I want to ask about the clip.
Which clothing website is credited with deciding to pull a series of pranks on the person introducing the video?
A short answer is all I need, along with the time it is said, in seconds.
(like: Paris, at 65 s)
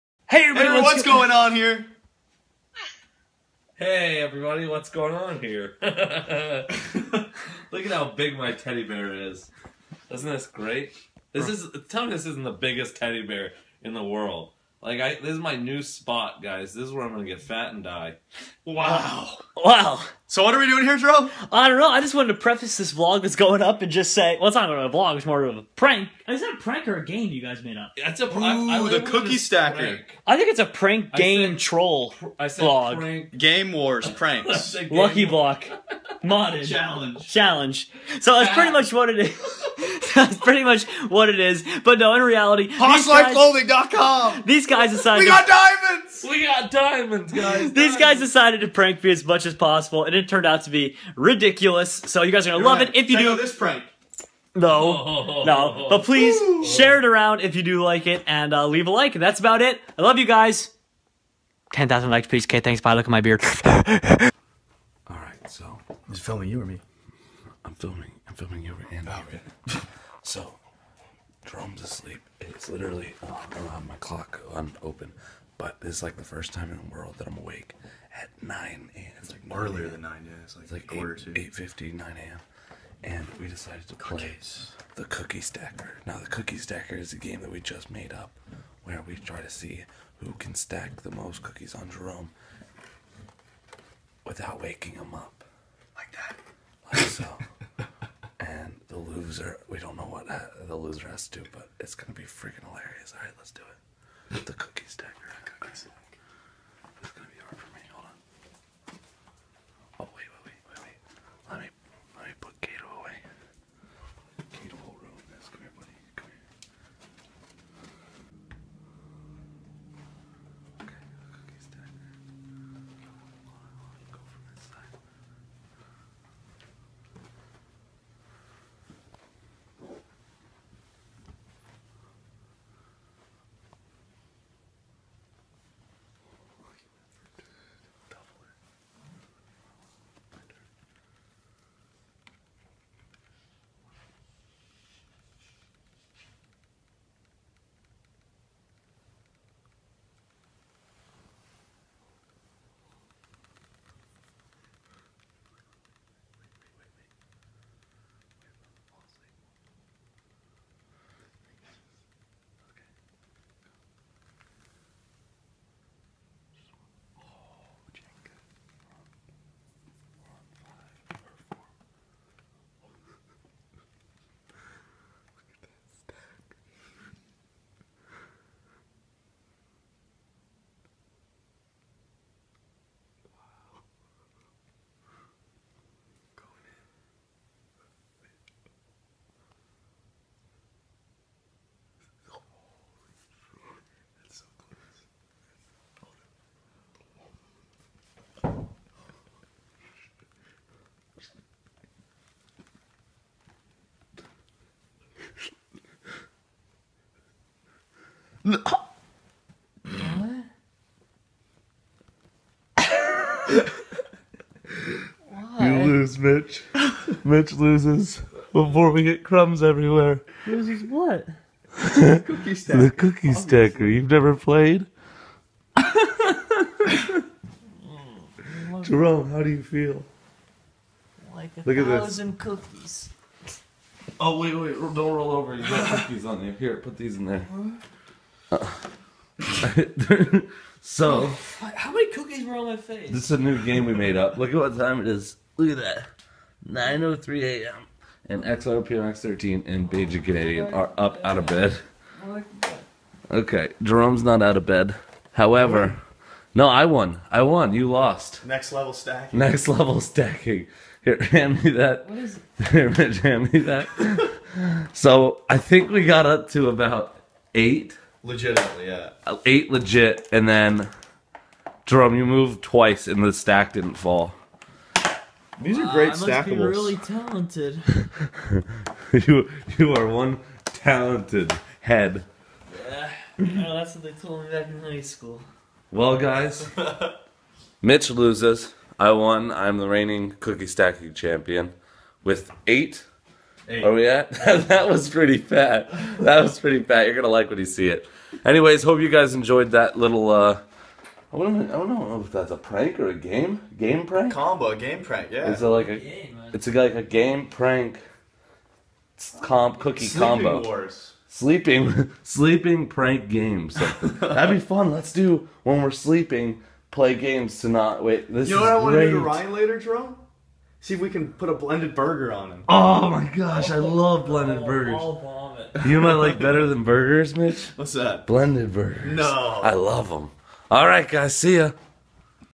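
PoshLifeClothing.com, at 42 s.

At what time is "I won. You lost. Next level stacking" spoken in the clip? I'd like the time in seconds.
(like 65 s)
257 s.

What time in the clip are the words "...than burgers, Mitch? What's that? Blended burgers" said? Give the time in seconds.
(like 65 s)
326 s.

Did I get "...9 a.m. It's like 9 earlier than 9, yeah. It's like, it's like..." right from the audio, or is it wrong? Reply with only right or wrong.
right.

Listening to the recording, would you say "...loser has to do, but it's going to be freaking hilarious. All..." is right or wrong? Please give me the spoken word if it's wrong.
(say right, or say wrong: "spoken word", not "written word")
right.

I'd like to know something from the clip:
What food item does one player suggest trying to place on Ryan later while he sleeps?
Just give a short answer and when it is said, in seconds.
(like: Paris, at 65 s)
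A blended burger, at 321 s.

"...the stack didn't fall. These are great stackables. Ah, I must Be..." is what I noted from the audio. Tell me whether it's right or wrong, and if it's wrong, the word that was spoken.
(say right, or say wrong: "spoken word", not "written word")
right.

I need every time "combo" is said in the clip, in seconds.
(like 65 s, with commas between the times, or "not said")
304 s, 310 s.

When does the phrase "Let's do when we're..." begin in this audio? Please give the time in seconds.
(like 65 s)
314 s.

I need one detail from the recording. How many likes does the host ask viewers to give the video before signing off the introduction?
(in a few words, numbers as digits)
10,000.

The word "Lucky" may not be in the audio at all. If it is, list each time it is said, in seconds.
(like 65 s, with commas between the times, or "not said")
34 s.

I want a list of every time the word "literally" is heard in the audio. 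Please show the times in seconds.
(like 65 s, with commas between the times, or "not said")
72 s.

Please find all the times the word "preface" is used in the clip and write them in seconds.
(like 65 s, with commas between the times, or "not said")
22 s.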